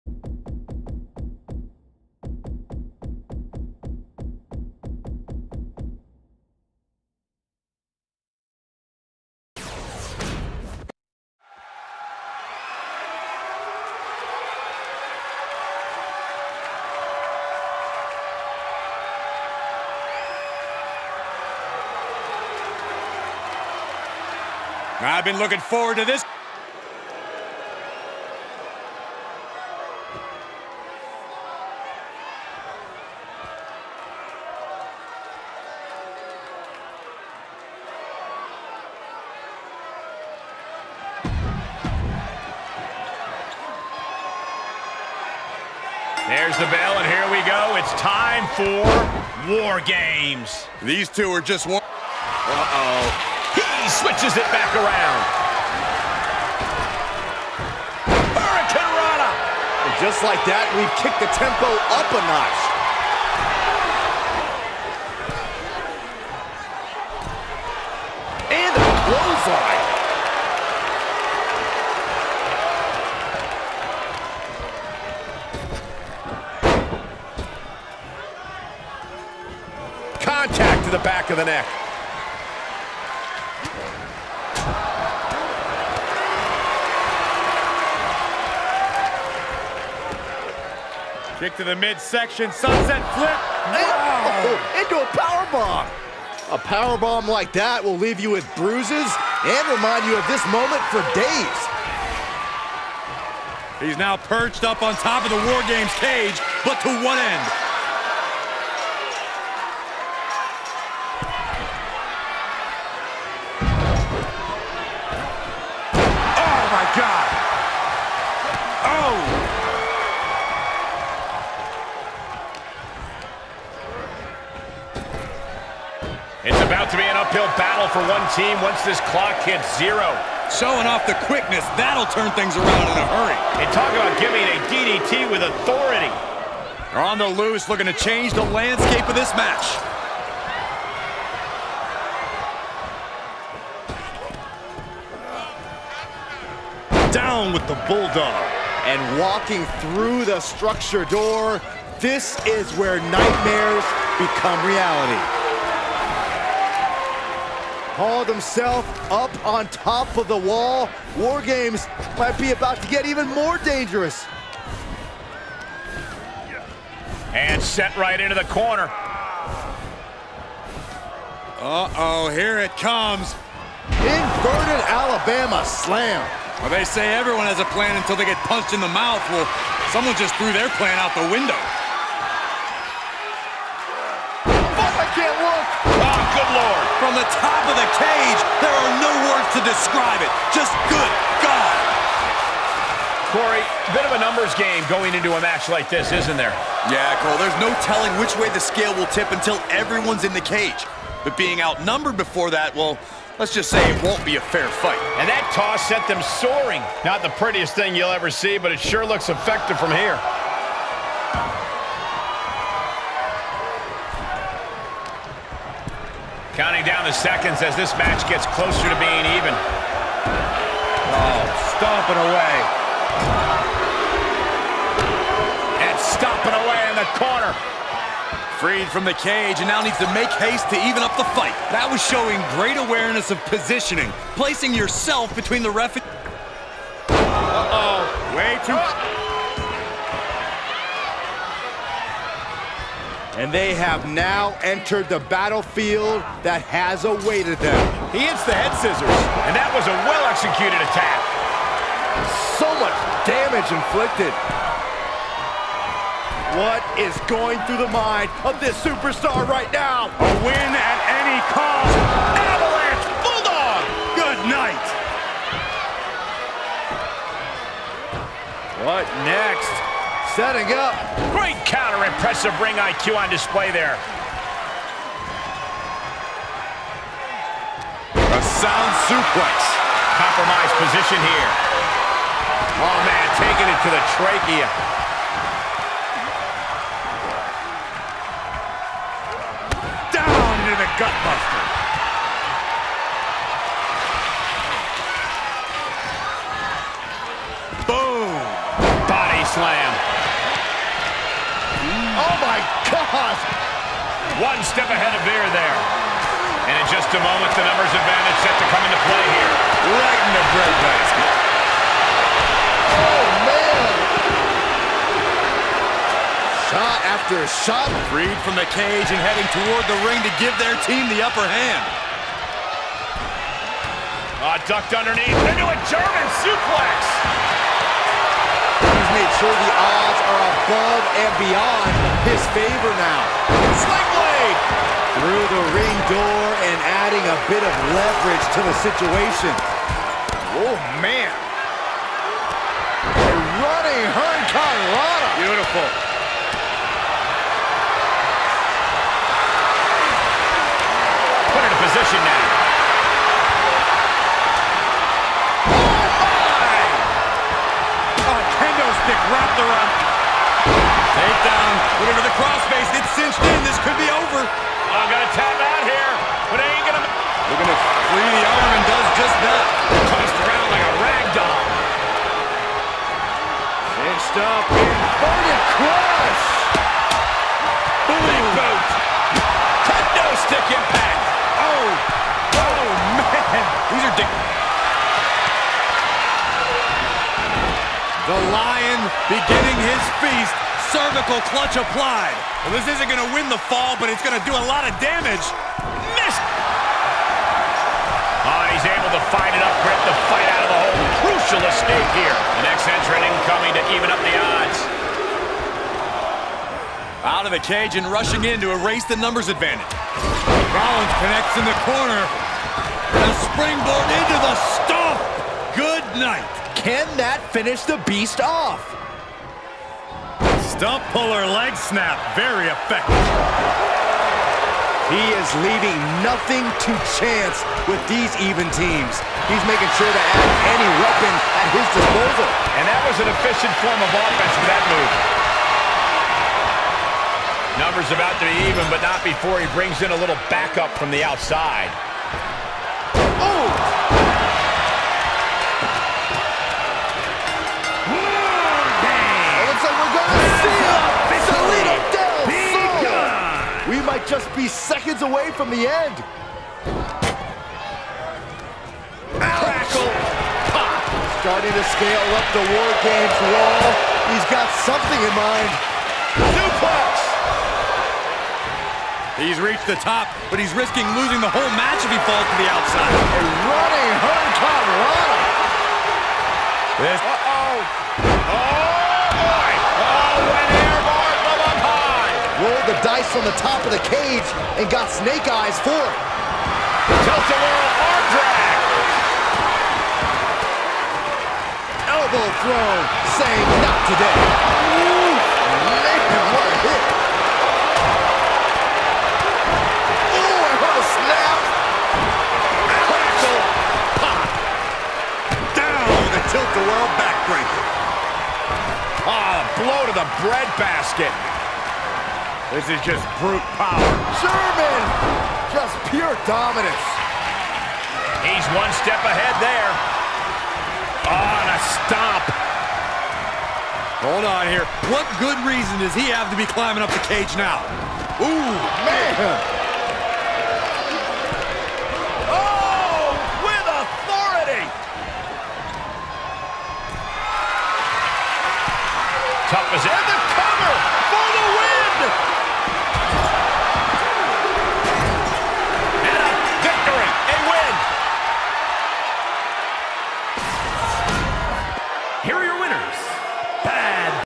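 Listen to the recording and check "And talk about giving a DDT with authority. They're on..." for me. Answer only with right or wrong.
right.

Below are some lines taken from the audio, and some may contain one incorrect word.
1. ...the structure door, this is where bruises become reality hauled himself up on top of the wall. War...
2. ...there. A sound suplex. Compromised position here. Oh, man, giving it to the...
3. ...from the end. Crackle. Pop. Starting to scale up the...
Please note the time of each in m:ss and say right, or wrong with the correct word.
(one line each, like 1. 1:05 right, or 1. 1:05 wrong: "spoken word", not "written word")
1. 2:30 wrong: "nightmares", not "bruises"
2. 4:33 wrong: "taking", not "giving"
3. 7:35 right.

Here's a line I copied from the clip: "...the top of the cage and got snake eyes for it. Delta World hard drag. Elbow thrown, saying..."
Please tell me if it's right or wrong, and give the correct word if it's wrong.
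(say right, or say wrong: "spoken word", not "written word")
right.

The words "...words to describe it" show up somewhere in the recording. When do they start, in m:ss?
3:09.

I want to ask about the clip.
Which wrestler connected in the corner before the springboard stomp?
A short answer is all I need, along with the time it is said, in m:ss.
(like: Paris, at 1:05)
Rollins, at 6:50.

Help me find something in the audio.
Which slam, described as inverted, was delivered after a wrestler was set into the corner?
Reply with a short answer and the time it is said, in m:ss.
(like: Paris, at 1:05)
Alabama slam, at 2:54.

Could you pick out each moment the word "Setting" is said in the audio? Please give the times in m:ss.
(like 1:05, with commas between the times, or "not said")
4:30.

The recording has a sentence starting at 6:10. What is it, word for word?
Tossed around like a rag doll.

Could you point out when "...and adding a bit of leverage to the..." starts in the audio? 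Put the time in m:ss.
5:36.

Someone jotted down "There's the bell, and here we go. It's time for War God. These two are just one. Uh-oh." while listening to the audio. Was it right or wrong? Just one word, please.
wrong.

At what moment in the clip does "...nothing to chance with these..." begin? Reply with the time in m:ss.
7:06.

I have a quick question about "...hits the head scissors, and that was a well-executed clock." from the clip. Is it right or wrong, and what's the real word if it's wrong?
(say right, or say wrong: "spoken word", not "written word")
wrong: "attack", not "clock".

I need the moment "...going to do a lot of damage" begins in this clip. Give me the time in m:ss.
6:34.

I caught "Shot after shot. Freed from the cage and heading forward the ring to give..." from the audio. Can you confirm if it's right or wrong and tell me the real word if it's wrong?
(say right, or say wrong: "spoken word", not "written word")
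wrong: "toward", not "forward".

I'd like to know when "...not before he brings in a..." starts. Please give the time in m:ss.
7:19.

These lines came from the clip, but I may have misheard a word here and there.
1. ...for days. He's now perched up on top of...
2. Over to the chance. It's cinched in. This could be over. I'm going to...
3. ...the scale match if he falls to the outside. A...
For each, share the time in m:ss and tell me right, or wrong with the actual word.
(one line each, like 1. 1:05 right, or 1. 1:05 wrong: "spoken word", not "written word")
1. 1:40 right
2. 6:02 wrong: "crossface", not "chance"
3. 7:51 wrong: "whole", not "scale".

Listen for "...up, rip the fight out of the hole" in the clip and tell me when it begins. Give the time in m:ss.
6:39.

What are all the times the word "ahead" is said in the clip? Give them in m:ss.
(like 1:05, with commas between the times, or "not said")
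5:04, 8:39.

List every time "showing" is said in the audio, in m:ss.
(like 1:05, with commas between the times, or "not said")
2:10, 3:52.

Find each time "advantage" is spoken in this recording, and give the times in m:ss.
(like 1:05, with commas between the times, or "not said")
5:07, 6:49.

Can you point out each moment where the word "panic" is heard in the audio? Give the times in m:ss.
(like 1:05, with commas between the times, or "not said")
not said.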